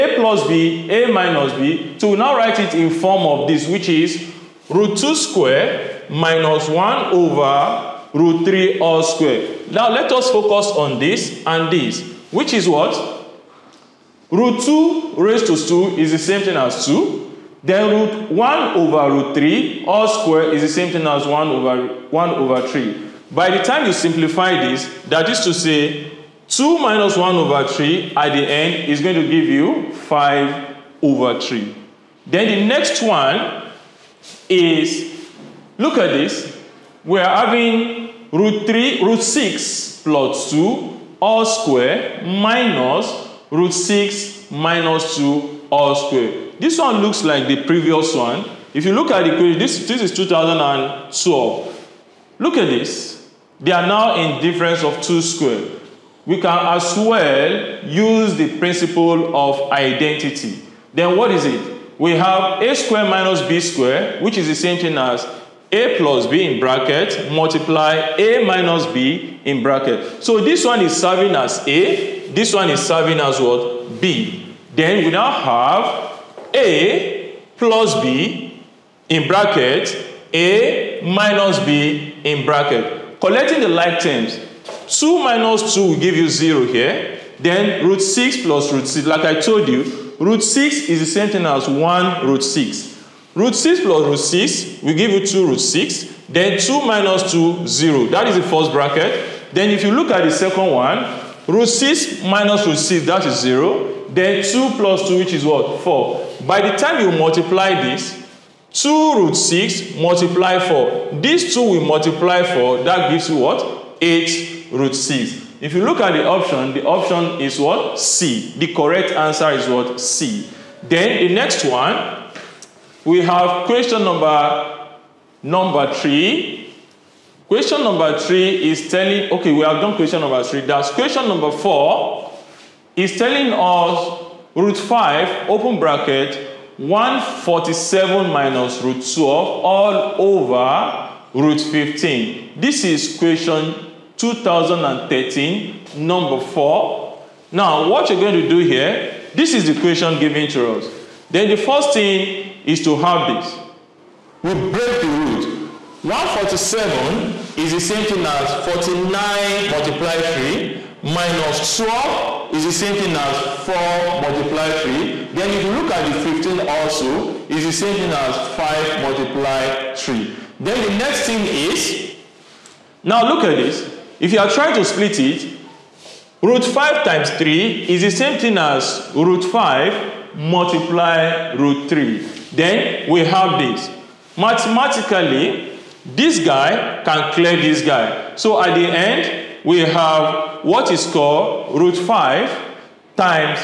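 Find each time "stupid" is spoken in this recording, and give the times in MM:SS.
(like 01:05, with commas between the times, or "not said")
not said.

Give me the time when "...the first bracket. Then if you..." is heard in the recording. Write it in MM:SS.
01:38.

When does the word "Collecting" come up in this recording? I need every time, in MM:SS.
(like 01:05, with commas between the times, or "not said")
01:23.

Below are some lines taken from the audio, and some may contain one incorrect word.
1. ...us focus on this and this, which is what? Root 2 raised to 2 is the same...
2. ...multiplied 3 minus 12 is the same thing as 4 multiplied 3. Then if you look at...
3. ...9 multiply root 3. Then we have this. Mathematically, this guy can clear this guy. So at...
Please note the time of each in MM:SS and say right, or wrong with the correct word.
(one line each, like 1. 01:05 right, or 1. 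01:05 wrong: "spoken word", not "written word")
1. 00:10 right
2. 02:39 right
3. 02:59 wrong: "5", not "9".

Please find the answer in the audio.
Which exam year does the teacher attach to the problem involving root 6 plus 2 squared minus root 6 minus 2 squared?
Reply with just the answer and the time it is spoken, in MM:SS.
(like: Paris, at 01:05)
2012, at 00:50.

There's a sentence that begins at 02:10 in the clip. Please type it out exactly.
That's question number four is telling us root 5, open bracket, 147 minus root 12 all over root 15.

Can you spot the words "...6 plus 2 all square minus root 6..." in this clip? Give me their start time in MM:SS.
00:39.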